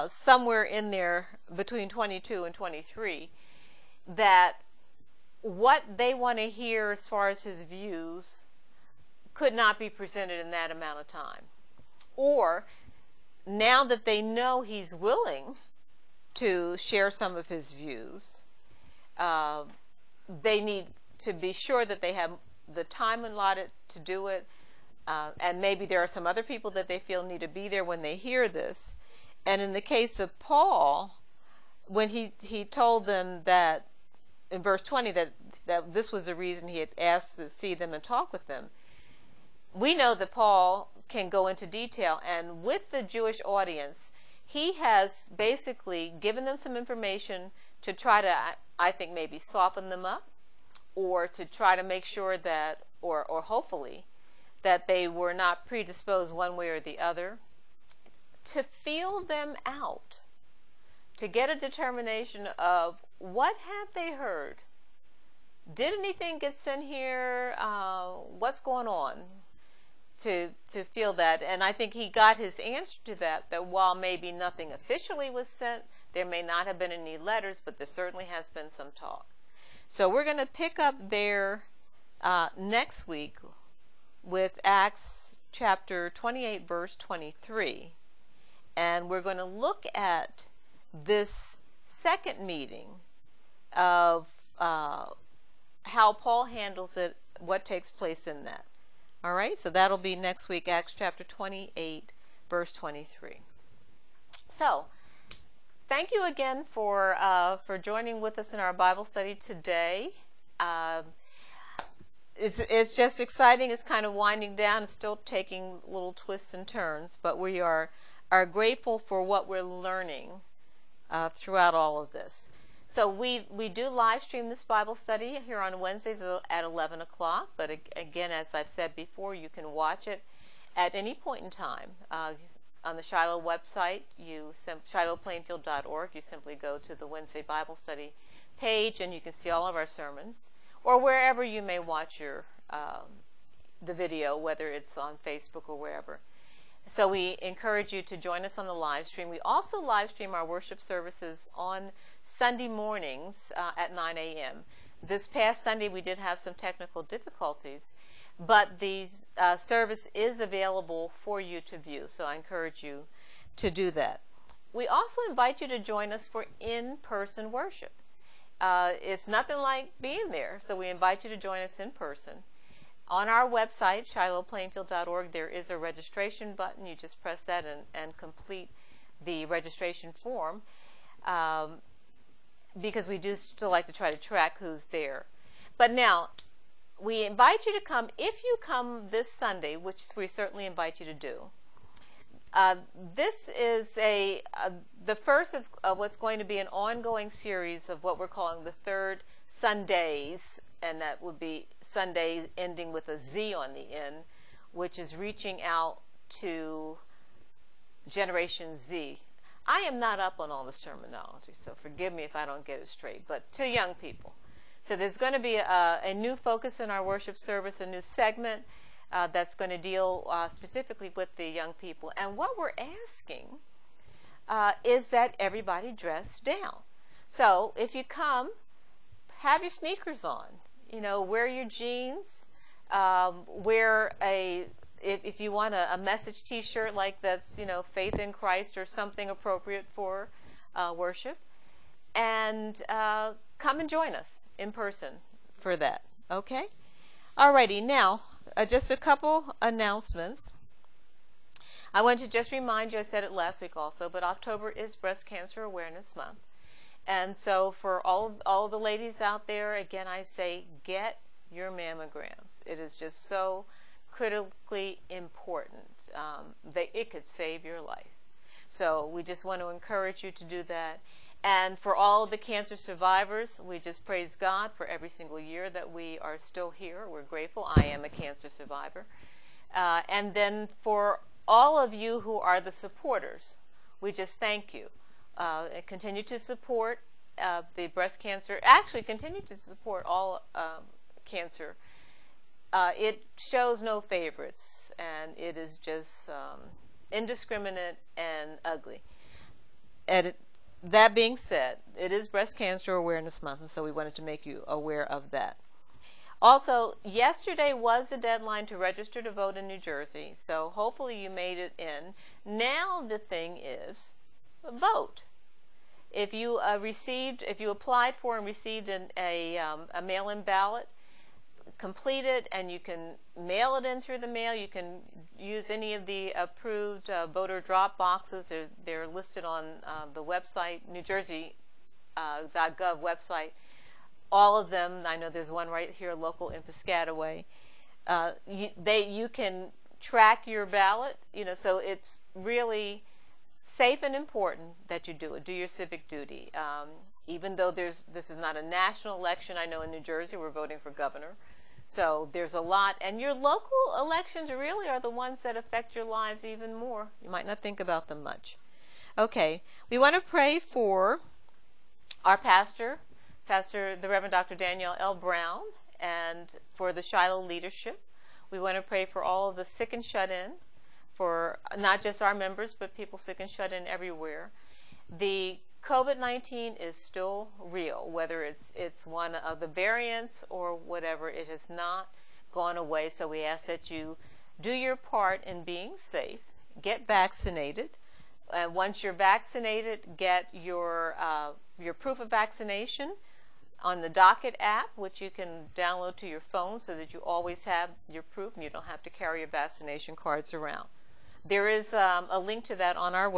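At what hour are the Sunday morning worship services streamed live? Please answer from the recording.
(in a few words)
9 a.m.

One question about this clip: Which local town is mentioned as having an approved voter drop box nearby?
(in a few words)
Piscataway.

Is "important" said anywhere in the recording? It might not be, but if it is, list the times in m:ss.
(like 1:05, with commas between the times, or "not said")
4:25, 5:44.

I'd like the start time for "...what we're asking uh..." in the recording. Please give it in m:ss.
3:42.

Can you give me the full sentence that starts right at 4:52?
Uh, it shows no favorites and it is just um, indiscriminate and ugly.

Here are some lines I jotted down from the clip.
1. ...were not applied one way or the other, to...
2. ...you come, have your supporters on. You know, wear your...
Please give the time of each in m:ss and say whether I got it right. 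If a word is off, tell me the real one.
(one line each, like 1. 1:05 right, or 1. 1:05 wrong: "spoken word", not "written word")
1. 0:55 wrong: "predisposed", not "applied"
2. 3:47 wrong: "sneakers", not "supporters".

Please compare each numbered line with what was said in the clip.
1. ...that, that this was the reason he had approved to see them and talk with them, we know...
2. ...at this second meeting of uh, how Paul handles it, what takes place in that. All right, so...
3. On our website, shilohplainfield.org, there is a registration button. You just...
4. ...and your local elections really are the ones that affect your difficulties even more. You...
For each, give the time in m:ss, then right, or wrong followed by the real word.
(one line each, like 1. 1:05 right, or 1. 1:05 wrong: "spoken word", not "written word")
1. 0:35 wrong: "asked", not "approved"
2. 1:29 right
3. 2:53 right
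4. 5:53 wrong: "lives", not "difficulties".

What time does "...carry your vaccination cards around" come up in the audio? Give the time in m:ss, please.
6:39.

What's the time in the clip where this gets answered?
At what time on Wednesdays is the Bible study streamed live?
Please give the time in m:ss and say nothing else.
2:06.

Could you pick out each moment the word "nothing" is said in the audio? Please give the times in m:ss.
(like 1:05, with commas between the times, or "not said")
1:14, 2:49.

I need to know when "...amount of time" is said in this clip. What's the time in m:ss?
0:10.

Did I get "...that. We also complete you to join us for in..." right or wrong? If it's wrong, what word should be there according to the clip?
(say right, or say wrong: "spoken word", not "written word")
wrong: "invite", not "complete".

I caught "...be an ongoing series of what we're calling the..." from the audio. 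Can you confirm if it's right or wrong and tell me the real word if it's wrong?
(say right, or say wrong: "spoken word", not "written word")
right.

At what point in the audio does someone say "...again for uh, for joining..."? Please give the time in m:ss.
1:46.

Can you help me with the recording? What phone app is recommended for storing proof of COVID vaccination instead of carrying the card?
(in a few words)
Docket.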